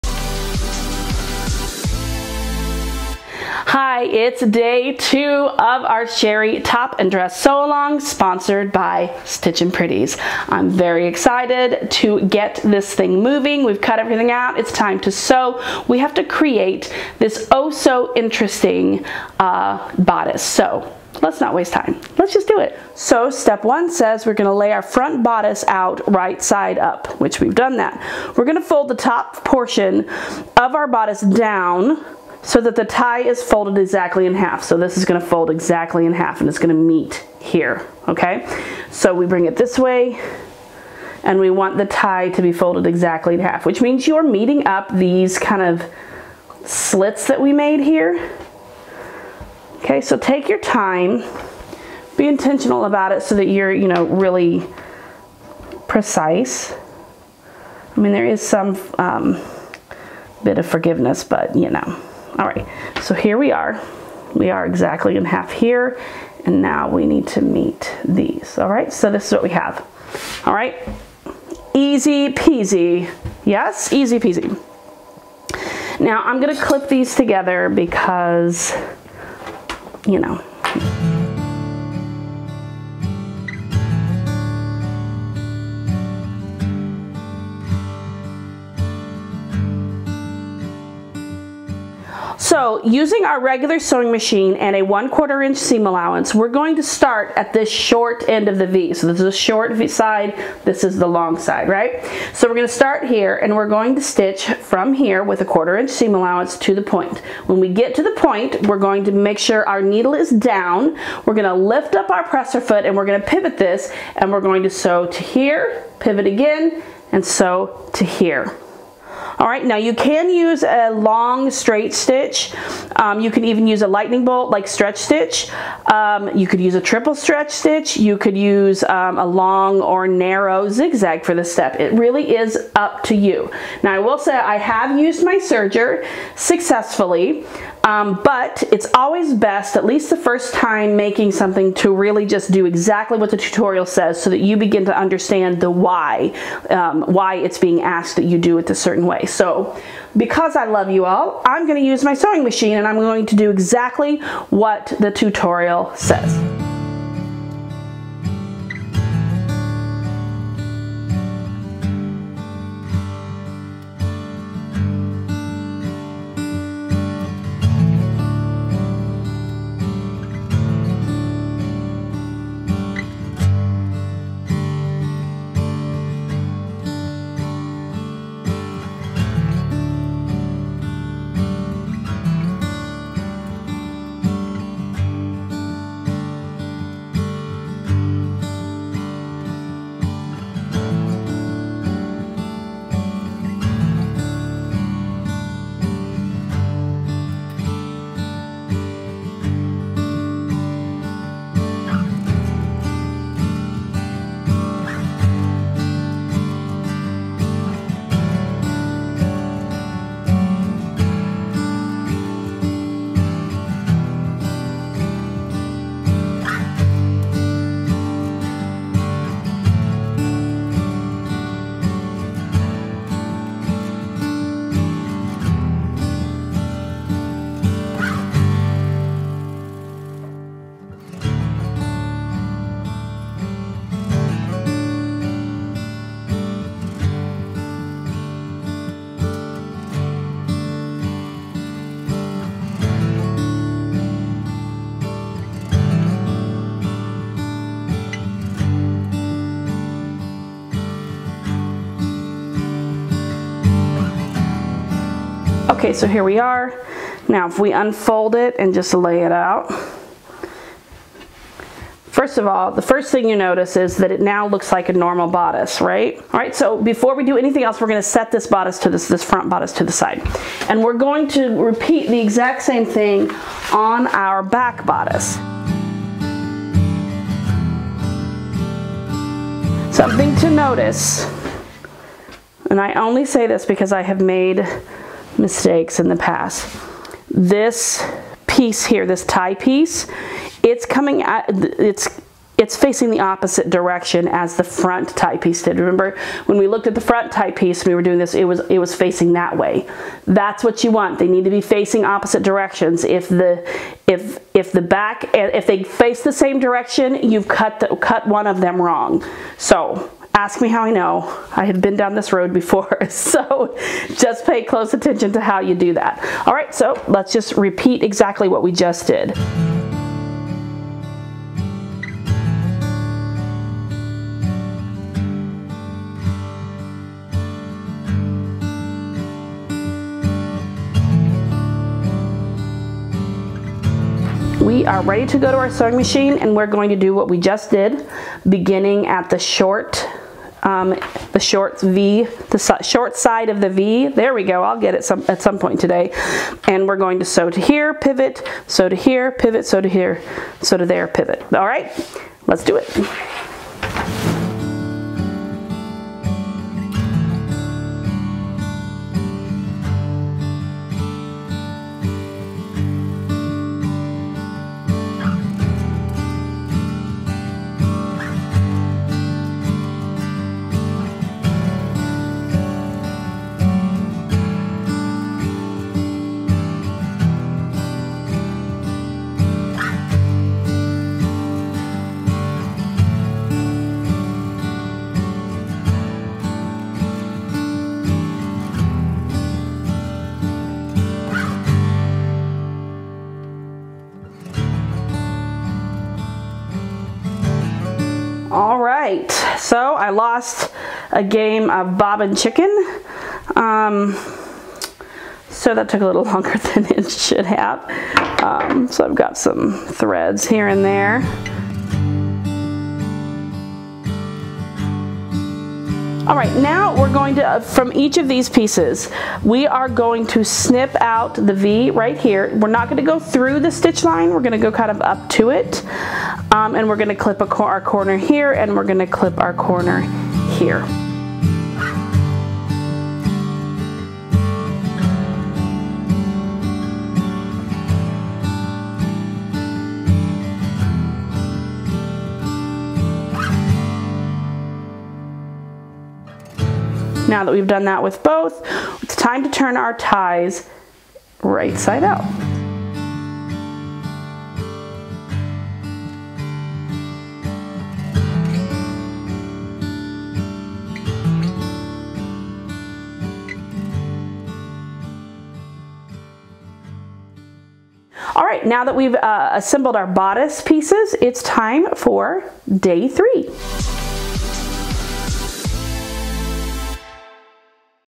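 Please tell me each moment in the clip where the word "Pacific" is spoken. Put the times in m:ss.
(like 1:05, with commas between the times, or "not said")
not said.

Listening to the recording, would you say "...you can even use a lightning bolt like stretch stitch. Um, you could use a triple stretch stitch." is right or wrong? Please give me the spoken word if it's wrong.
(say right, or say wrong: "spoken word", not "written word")
right.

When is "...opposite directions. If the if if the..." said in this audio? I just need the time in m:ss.
5:02.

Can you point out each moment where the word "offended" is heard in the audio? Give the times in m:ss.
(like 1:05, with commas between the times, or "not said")
not said.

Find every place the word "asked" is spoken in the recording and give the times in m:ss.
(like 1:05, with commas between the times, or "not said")
2:27.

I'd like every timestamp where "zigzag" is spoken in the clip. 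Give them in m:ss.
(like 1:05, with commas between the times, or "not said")
2:10.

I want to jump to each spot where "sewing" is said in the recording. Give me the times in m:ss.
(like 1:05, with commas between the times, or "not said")
1:33, 2:32, 5:35.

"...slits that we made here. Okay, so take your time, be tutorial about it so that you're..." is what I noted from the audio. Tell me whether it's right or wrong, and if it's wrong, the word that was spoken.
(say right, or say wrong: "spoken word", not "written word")
wrong: "intentional", not "tutorial".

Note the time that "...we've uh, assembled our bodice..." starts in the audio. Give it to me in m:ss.
7:48.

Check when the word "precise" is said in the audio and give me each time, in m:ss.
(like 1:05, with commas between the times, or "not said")
0:55.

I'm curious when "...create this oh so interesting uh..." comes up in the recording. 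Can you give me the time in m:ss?
0:16.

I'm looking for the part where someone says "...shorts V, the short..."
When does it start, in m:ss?
5:41.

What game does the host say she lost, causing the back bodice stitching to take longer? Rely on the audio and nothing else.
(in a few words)
Bobbin chicken.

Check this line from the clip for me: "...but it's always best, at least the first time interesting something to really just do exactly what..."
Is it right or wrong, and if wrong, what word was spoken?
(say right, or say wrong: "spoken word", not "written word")
wrong: "making", not "interesting".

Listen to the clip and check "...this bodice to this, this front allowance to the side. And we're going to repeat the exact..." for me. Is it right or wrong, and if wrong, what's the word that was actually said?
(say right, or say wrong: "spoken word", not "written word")
wrong: "bodice", not "allowance".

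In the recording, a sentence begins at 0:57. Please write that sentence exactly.
I mean, there is some um, bit of forgiveness, but you know.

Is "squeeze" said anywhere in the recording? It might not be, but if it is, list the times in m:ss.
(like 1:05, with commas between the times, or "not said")
not said.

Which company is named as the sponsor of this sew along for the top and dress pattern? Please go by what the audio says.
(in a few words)
Stitchin' Pretties.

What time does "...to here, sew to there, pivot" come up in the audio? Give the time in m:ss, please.
5:49.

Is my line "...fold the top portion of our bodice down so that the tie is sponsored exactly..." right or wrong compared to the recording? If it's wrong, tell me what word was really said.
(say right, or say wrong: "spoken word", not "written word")
wrong: "folded", not "sponsored".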